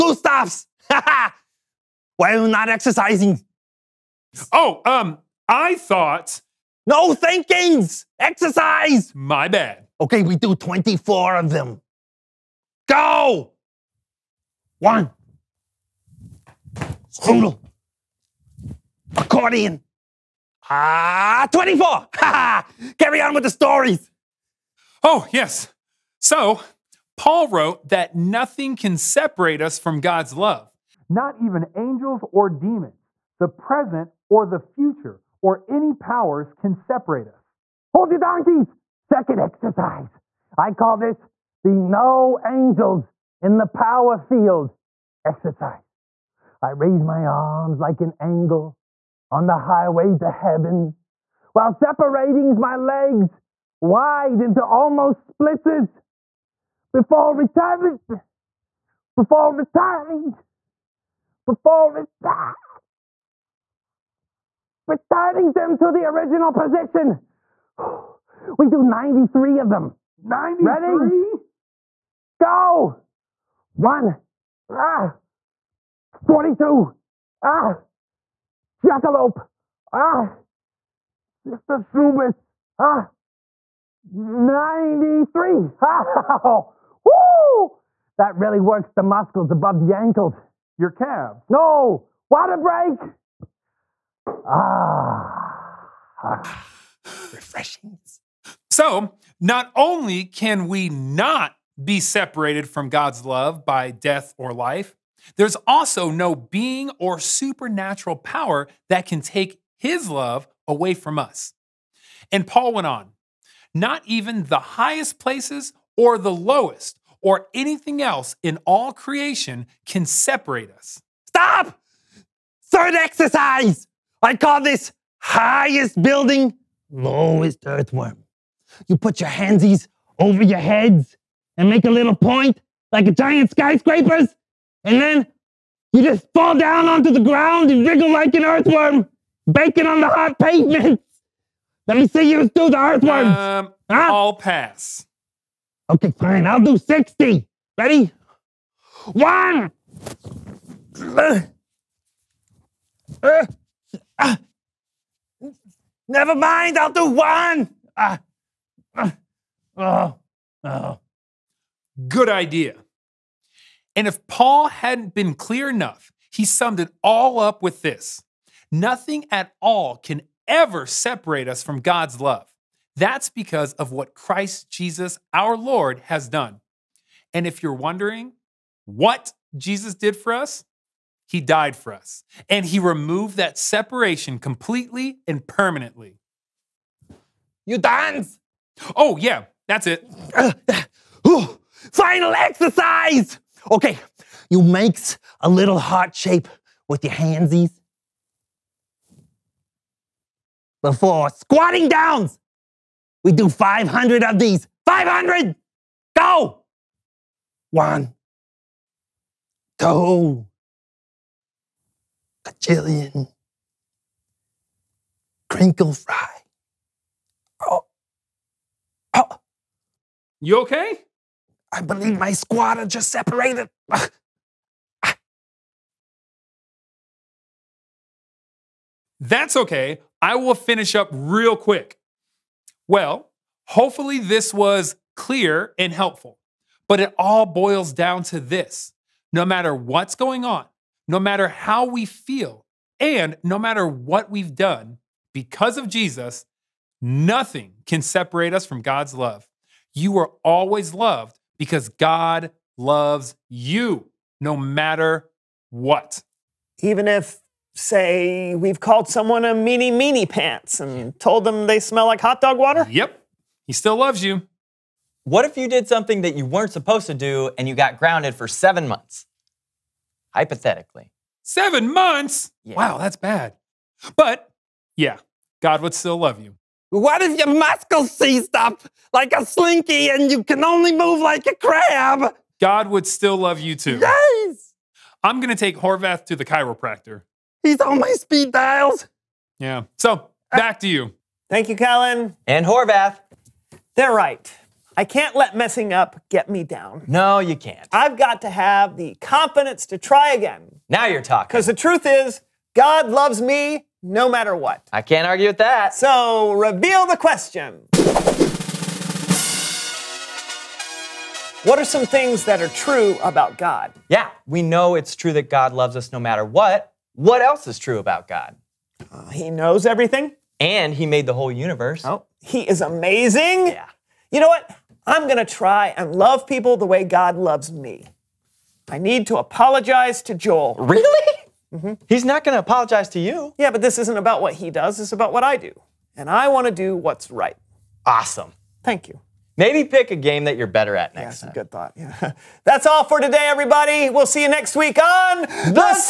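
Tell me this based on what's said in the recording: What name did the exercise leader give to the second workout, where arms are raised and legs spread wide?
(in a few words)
No angels in the power field.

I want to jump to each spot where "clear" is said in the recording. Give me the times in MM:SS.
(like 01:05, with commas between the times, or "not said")
02:45, 03:55.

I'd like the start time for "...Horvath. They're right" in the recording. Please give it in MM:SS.
04:52.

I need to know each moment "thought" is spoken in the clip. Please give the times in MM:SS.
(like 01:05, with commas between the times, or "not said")
00:05, 05:41.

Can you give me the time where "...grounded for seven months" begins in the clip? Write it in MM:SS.
04:27.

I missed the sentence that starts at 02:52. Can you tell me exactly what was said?
That's because of what Christ Jesus, our Lord, has done.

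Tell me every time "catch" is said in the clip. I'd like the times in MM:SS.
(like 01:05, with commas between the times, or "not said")
not said.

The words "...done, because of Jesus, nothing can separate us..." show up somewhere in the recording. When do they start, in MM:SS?
04:04.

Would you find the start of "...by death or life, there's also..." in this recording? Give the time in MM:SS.
01:43.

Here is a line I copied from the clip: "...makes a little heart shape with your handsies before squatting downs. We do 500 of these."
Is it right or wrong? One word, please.
right.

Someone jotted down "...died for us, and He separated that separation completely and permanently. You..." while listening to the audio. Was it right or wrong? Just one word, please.
wrong.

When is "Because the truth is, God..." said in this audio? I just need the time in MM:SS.
05:01.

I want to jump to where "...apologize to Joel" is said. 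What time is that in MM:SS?
05:29.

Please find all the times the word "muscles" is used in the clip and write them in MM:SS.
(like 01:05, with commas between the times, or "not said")
01:29, 04:37.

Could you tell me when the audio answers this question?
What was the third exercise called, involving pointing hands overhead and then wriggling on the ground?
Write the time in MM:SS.
02:05.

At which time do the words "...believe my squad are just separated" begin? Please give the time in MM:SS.
03:41.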